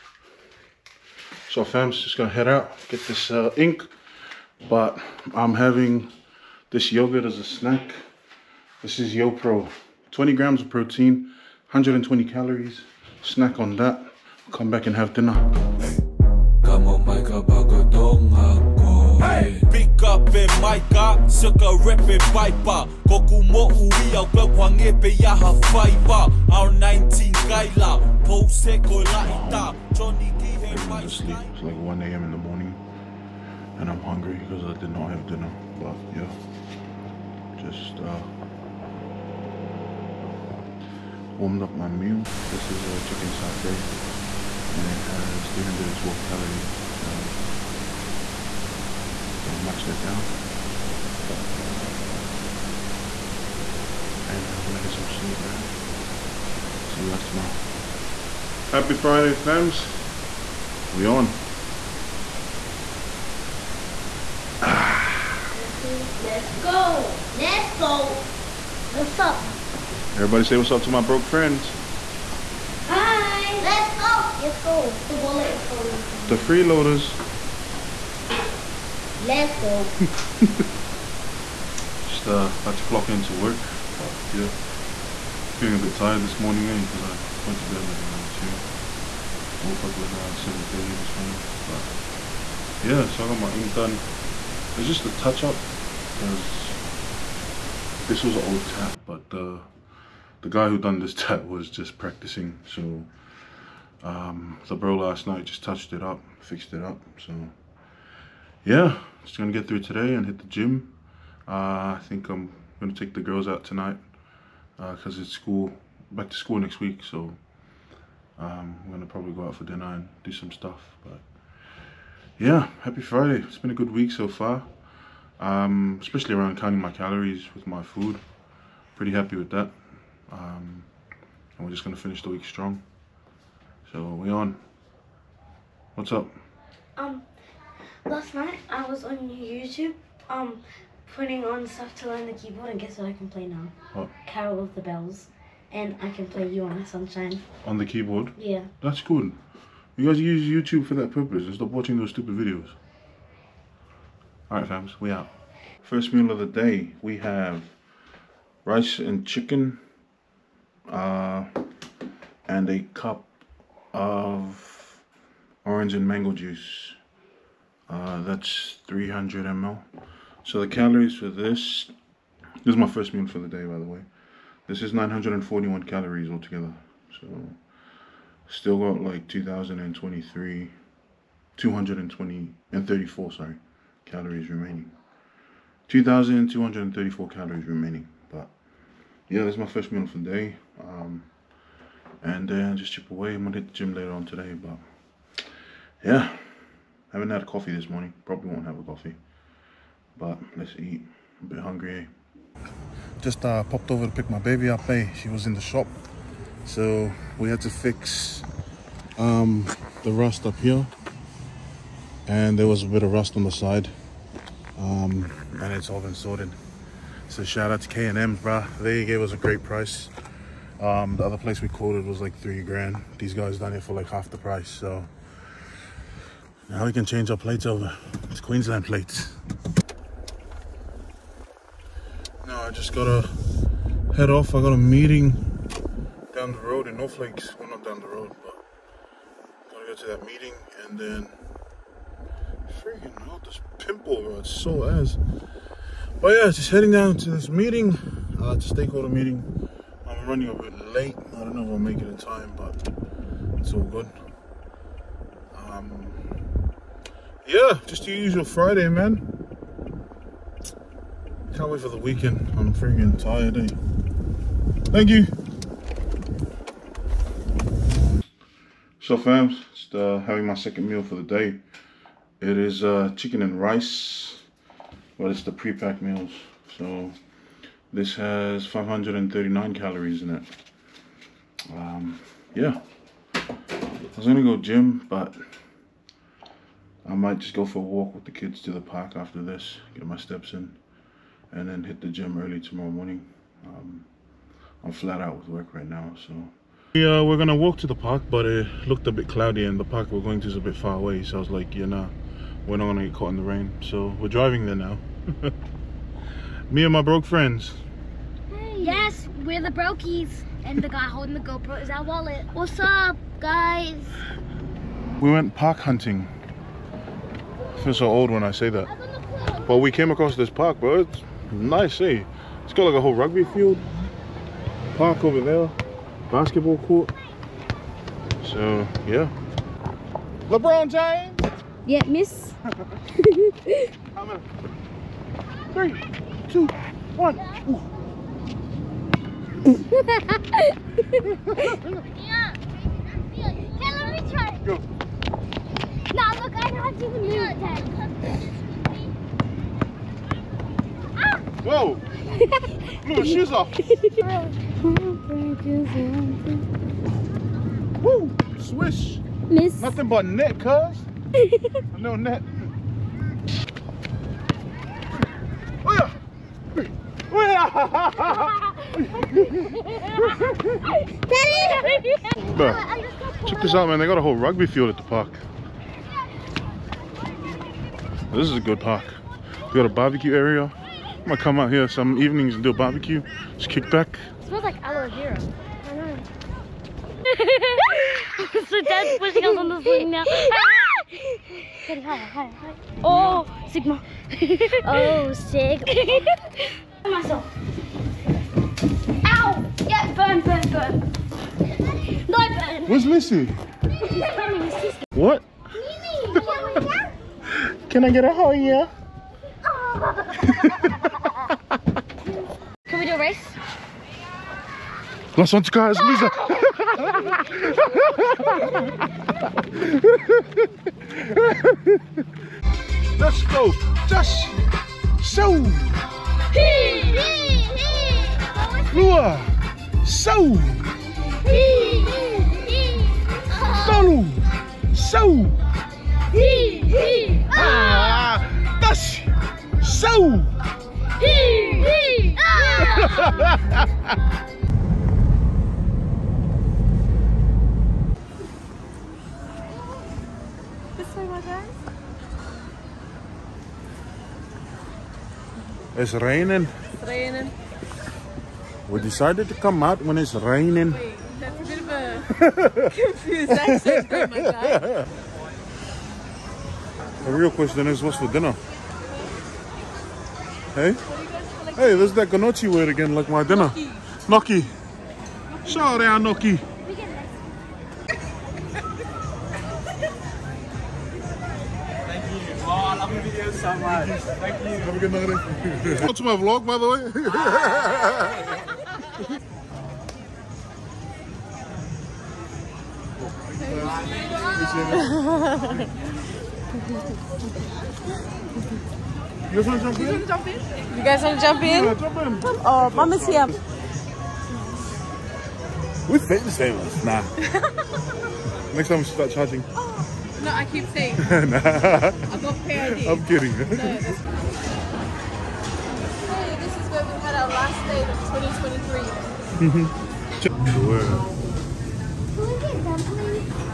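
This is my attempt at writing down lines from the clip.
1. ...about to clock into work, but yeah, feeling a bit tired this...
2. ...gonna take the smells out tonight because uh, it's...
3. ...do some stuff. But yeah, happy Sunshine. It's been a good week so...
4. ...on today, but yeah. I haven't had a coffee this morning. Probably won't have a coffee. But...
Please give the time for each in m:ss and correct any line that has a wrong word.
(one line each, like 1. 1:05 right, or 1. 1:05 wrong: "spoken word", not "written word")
1. 1:22 right
2. 1:52 wrong: "girls", not "smells"
3. 2:00 wrong: "Friday", not "Sunshine"
4. 3:14 right.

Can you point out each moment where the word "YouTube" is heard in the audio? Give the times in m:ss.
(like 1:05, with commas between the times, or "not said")
2:19, 2:30.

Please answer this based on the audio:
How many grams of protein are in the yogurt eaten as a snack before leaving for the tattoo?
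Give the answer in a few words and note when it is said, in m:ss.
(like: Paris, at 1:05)
20 grams, at 0:10.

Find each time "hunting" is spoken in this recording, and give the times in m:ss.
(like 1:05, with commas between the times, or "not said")
5:15.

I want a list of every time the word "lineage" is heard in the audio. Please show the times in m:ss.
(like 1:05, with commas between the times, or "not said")
not said.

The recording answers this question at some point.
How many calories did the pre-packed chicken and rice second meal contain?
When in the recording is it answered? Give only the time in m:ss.
4:38.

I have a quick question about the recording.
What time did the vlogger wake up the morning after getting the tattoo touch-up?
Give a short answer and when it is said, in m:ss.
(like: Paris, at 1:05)
7:30, at 1:30.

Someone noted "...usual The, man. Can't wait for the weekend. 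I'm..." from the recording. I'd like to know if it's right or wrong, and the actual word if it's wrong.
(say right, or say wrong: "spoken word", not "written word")
wrong: "Friday", not "The".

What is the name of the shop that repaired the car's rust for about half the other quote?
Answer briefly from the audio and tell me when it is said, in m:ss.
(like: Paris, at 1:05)
K&M, at 3:37.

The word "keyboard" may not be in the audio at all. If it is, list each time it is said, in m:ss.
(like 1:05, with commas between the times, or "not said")
2:22, 2:27.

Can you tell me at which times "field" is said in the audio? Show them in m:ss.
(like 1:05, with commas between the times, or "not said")
5:23, 6:14.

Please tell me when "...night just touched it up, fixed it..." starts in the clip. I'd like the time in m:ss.
1:45.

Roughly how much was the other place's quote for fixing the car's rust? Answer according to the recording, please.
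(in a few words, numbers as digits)
three grand.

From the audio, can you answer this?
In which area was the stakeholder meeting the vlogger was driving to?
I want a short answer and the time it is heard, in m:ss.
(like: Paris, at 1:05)
North Lakes, at 3:56.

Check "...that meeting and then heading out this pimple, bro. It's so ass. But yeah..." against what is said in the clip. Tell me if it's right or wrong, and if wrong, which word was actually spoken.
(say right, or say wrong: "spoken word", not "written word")
wrong: "freaking", not "heading".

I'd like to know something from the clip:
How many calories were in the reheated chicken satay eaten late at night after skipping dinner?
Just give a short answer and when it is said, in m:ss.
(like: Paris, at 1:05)
312, at 0:45.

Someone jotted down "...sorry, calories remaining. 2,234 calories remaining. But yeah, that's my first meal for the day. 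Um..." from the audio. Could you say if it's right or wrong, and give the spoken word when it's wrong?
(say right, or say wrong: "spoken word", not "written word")
right.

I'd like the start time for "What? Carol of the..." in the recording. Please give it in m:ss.
2:23.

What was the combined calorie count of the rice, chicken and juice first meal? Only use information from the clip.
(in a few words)
941.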